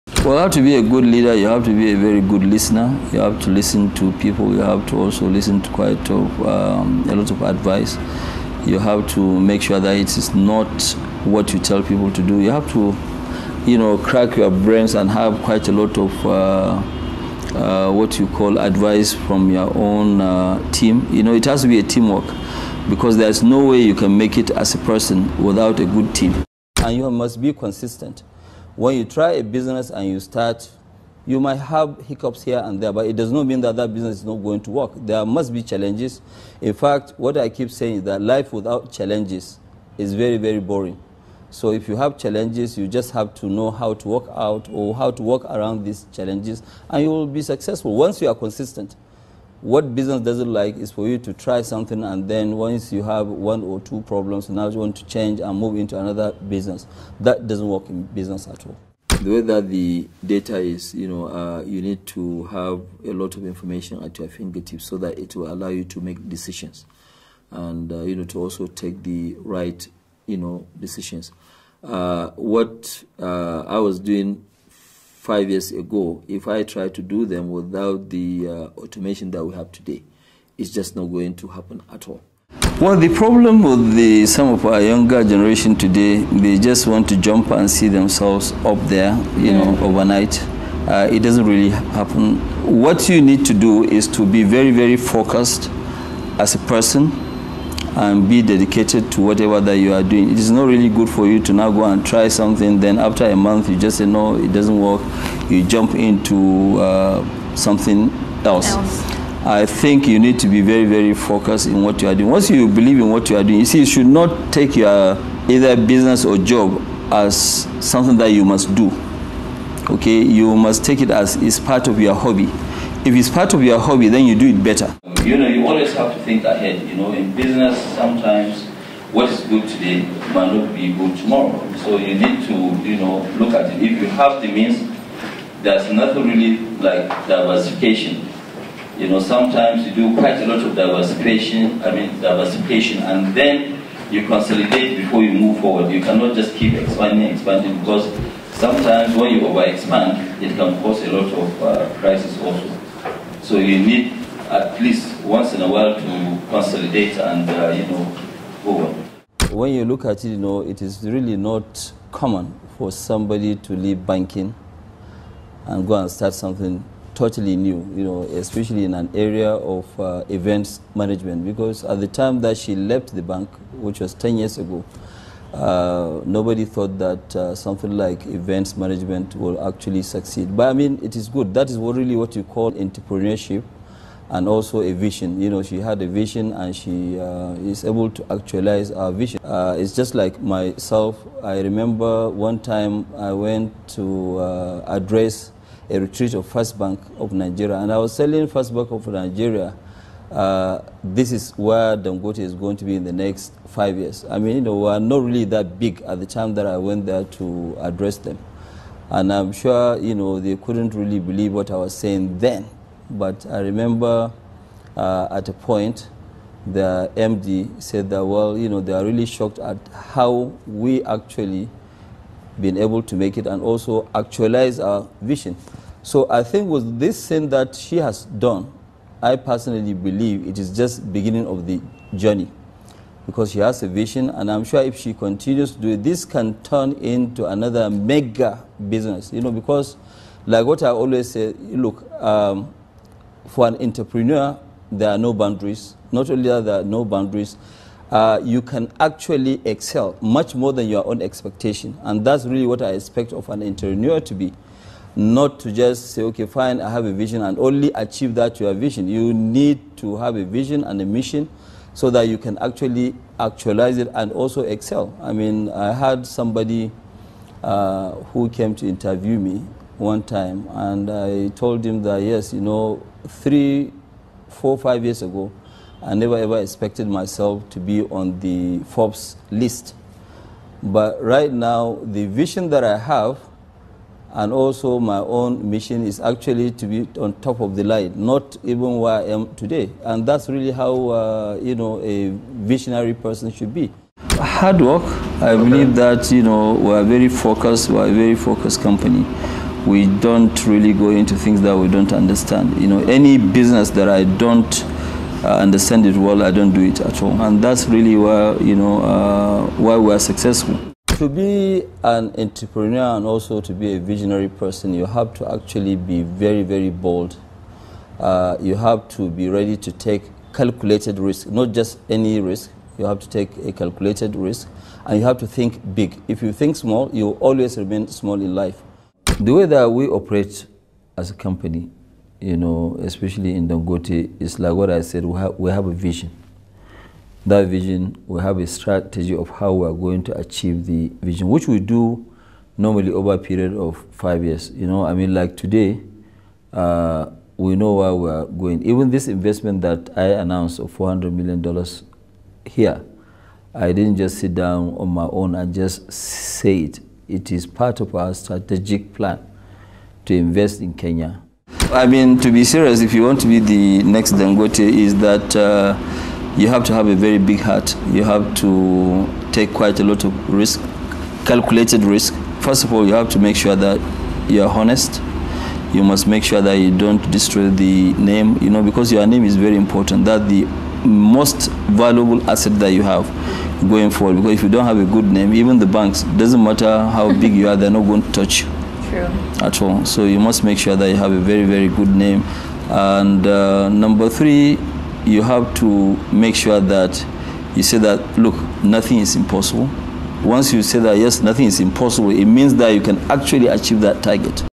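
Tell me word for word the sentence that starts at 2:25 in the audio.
You cannot just keep expanding, expanding, because sometimes when you overexpand, it can cause a lot of uh, crisis also.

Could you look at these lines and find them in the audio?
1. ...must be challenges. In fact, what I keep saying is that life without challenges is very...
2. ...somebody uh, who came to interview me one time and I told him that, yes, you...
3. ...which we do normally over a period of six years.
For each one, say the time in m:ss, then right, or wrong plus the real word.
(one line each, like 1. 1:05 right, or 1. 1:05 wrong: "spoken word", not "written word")
1. 0:35 right
2. 4:26 right
3. 5:41 wrong: "five", not "six".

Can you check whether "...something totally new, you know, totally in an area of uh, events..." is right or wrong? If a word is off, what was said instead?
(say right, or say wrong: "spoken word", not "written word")
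wrong: "especially", not "totally".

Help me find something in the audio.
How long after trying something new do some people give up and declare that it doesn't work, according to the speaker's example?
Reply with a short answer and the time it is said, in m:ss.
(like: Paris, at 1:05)
a month, at 1:42.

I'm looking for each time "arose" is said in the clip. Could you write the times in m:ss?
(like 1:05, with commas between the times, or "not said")
not said.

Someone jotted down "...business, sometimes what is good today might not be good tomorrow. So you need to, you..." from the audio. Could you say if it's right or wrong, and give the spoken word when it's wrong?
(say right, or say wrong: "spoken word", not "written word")
right.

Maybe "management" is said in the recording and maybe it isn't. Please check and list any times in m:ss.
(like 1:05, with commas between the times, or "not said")
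2:50, 2:58.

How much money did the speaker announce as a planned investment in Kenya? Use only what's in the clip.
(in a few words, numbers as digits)
$400 million.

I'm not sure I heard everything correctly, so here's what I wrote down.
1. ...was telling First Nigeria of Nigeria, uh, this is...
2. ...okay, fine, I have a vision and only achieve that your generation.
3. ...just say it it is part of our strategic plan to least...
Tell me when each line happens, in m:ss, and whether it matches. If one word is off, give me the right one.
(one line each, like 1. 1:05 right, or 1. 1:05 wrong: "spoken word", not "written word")
1. 3:17 wrong: "Bank", not "Nigeria"
2. 4:16 wrong: "vision", not "generation"
3. 5:55 wrong: "invest", not "least".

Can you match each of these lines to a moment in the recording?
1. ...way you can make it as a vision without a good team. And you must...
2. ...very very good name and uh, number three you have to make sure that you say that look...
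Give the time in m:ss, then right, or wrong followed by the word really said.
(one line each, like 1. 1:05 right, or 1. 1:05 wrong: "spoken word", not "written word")
1. 0:23 wrong: "person", not "vision"
2. 6:31 right.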